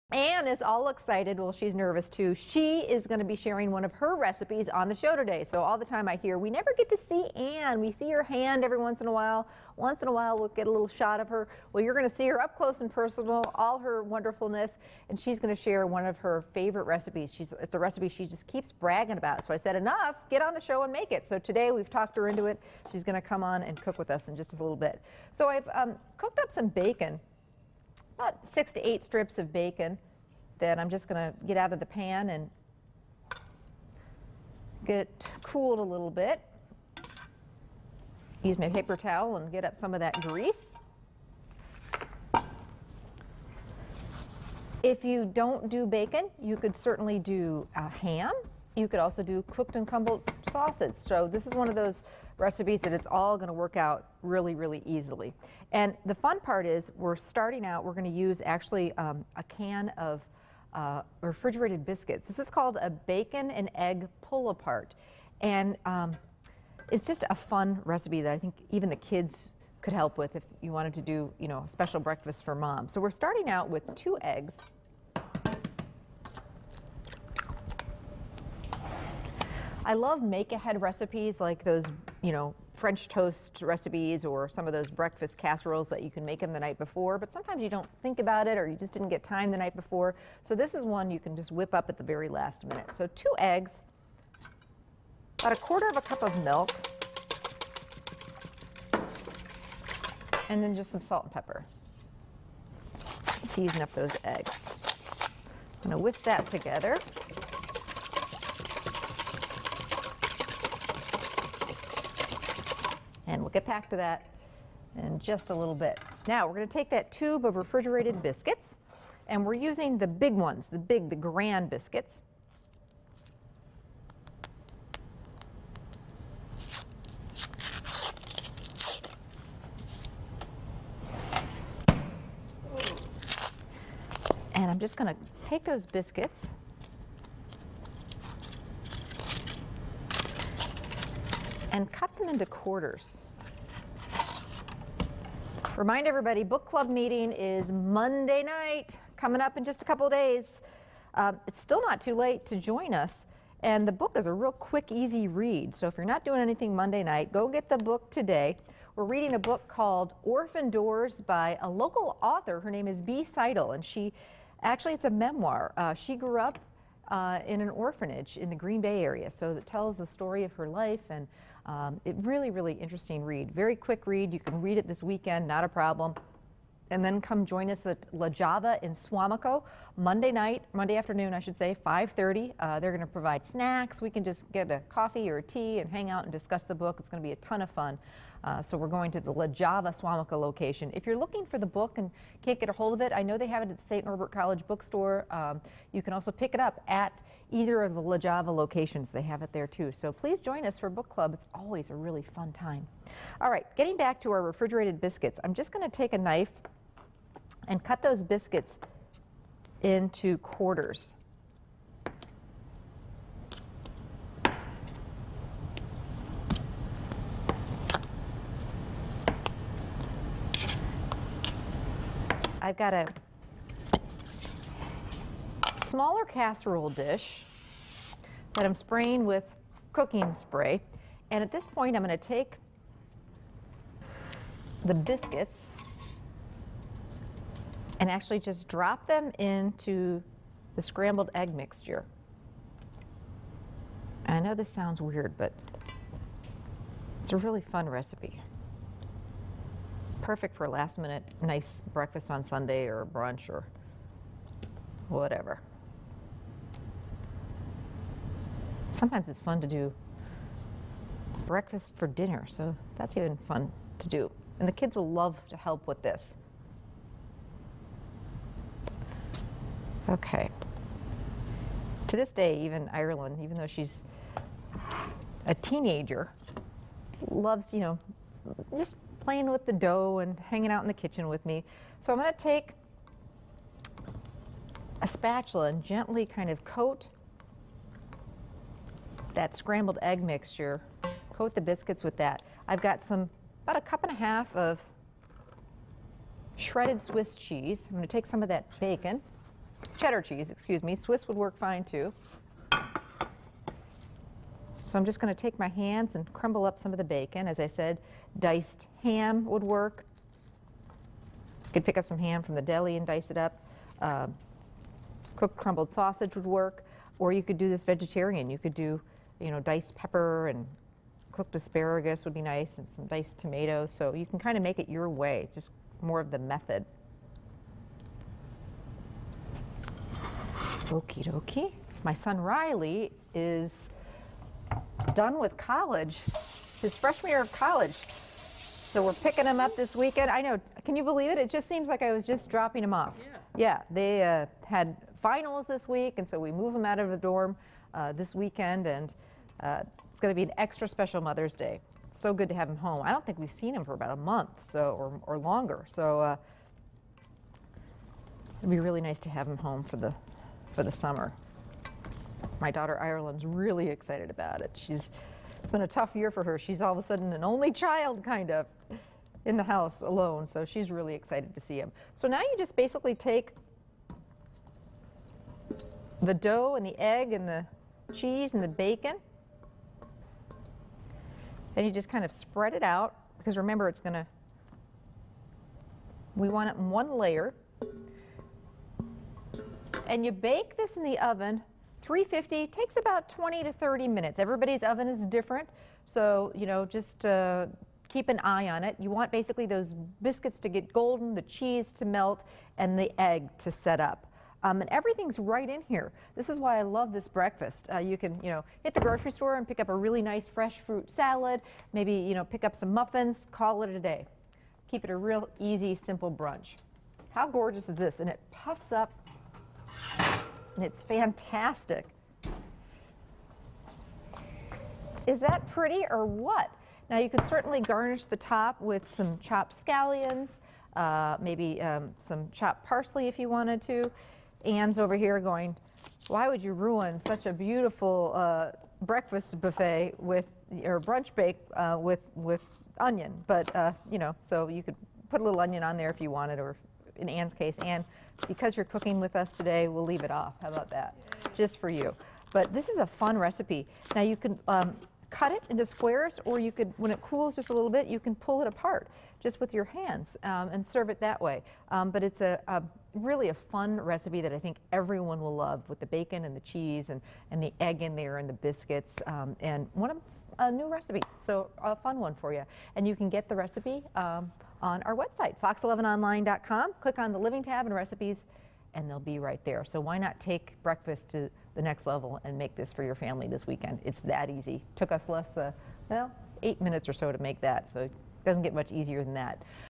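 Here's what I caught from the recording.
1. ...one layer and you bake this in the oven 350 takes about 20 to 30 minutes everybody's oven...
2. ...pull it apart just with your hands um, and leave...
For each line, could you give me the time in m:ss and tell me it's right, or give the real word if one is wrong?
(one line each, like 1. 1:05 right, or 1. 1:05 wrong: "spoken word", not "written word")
1. 6:26 right
2. 7:38 wrong: "serve", not "leave".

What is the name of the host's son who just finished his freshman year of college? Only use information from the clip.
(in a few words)
Riley.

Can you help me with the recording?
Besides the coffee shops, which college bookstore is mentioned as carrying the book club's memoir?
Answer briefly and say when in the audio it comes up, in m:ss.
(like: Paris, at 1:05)
St. Norbert College, at 3:13.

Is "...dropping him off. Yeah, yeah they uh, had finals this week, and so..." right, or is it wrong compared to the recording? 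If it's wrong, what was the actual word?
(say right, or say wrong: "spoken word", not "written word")
right.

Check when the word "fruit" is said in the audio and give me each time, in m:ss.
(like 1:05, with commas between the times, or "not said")
6:50.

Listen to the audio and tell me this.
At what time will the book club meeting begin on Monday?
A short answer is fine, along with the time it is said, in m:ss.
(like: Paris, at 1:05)
5:30, at 3:01.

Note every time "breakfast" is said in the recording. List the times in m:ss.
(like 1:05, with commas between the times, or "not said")
1:11, 1:24, 4:11, 4:21, 6:47, 7:19, 8:00.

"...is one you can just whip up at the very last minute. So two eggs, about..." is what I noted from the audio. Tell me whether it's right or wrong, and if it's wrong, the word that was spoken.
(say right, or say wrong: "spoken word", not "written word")
right.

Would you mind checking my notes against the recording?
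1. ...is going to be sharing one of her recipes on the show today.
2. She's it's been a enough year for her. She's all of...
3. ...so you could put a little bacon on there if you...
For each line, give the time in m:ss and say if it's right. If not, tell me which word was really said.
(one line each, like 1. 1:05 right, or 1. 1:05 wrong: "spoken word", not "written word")
1. 0:02 right
2. 6:04 wrong: "tough", not "enough"
3. 7:24 wrong: "onion", not "bacon".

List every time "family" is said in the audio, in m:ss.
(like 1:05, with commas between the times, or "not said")
8:03.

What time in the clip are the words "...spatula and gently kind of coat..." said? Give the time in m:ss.
4:45.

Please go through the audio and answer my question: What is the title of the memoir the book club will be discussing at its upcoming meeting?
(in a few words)
Orphan Doors.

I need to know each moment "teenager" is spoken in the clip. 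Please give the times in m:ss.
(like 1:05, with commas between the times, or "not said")
4:35.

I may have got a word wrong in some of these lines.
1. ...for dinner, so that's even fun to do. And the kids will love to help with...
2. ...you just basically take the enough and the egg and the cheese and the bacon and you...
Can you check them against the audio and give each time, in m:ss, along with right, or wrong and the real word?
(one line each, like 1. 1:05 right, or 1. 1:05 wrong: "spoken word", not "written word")
1. 4:21 right
2. 6:12 wrong: "dough", not "enough".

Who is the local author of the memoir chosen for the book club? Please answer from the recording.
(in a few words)
B. Seidel.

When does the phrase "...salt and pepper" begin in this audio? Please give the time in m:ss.
1:41.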